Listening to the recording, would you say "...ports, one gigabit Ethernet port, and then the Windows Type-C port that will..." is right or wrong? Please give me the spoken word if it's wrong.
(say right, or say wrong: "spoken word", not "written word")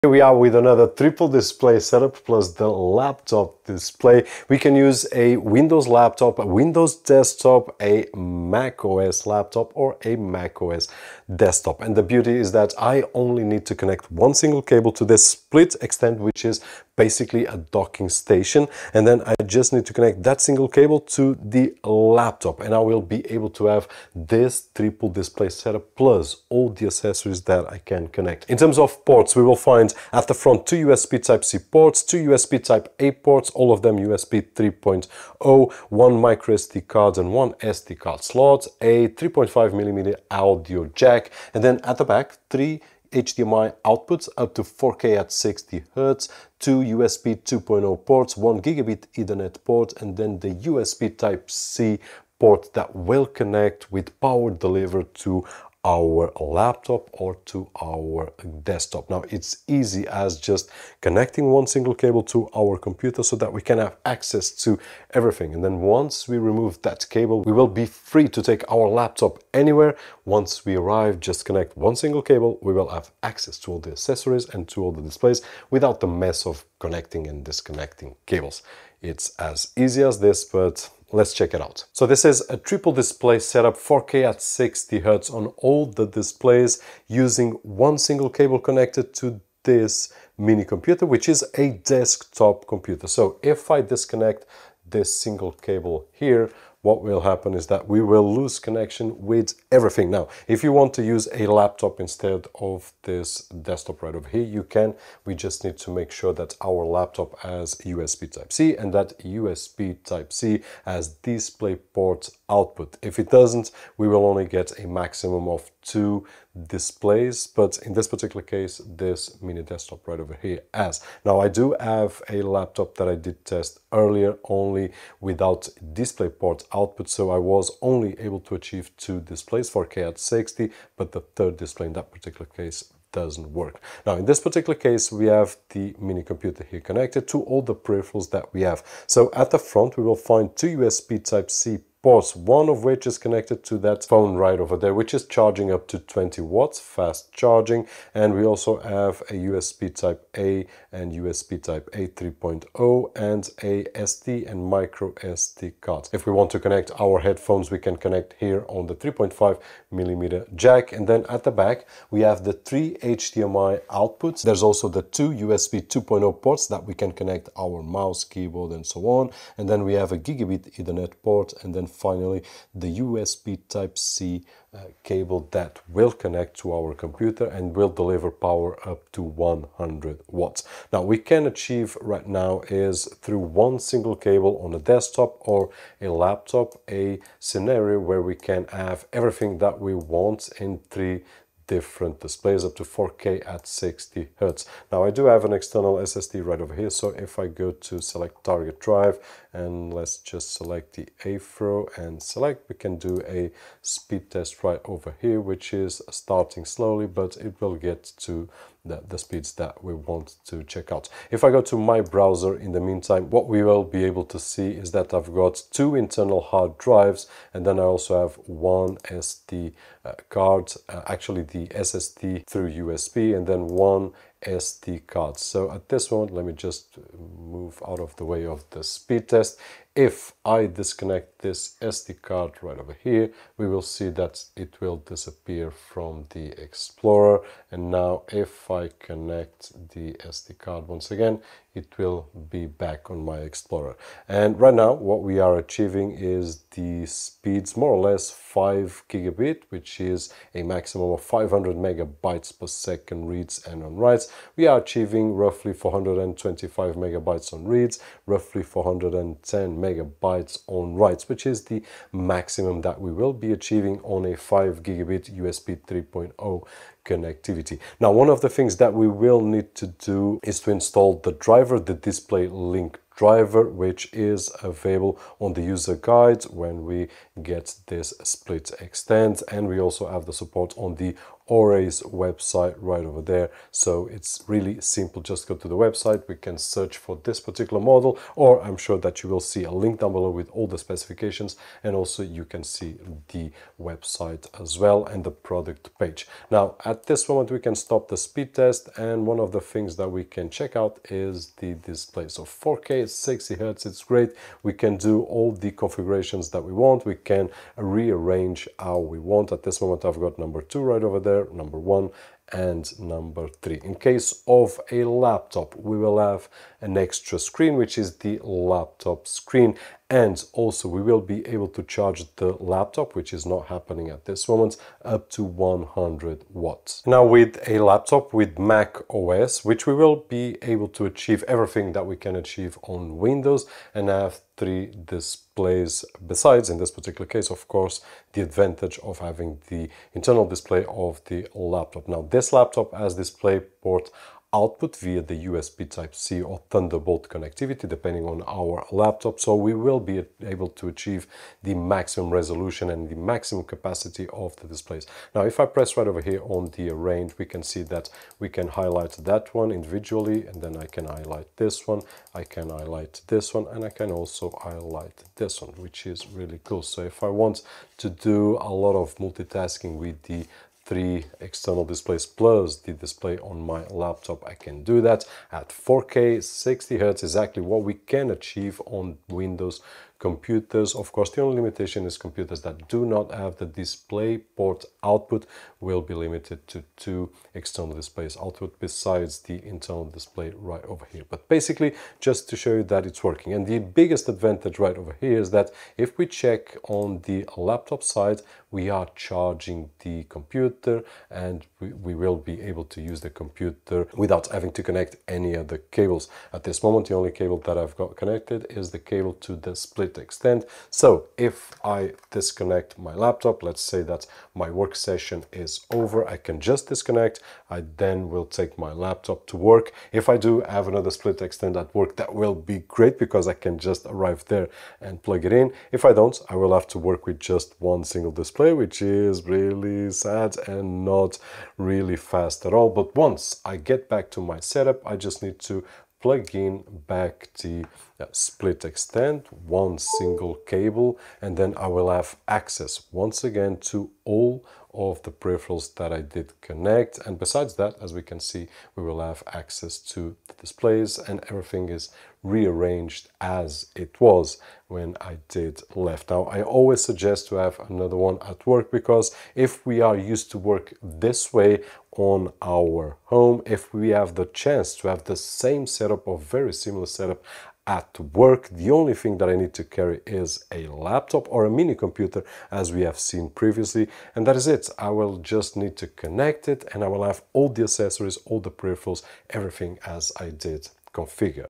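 wrong: "USB", not "Windows".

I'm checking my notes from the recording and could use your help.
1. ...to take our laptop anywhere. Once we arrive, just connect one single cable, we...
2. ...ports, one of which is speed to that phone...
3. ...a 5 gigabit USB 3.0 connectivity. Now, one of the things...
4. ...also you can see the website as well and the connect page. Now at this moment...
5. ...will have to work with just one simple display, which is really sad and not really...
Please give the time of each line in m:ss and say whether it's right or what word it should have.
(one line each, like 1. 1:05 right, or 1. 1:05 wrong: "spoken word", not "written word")
1. 1:08 right
2. 2:22 wrong: "connected", not "speed"
3. 4:24 right
4. 4:51 wrong: "product", not "connect"
5. 7:06 wrong: "single", not "simple".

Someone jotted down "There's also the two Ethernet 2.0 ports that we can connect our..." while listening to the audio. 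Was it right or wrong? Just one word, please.
wrong.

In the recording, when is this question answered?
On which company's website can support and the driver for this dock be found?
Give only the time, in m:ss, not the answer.
4:41.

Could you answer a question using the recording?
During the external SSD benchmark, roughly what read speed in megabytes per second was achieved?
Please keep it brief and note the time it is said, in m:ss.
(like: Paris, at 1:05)
425 megabytes, at 4:15.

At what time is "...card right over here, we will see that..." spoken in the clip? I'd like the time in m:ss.
3:52.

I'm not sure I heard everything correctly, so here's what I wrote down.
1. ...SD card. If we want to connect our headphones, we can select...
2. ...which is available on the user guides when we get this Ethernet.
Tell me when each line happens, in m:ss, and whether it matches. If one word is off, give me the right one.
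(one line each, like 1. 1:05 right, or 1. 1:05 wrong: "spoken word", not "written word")
1. 2:35 wrong: "connect", not "select"
2. 4:33 wrong: "SplitXtend", not "Ethernet".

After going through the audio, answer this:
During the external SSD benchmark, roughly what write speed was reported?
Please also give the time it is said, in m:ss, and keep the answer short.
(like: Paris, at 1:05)
410 megabytes, at 4:18.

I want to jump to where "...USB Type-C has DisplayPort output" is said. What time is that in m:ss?
1:49.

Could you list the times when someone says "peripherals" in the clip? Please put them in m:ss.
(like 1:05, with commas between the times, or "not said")
2:17, 7:25, 7:58.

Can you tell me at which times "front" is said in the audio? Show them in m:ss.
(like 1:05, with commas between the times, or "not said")
0:30, 2:19.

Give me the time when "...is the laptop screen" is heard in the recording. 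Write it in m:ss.
5:17.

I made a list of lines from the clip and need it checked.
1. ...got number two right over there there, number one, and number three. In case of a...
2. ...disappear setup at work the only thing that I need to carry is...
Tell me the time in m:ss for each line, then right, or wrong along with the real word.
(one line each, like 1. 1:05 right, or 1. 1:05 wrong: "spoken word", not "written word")
1. 5:10 right
2. 7:46 wrong: "similar", not "disappear".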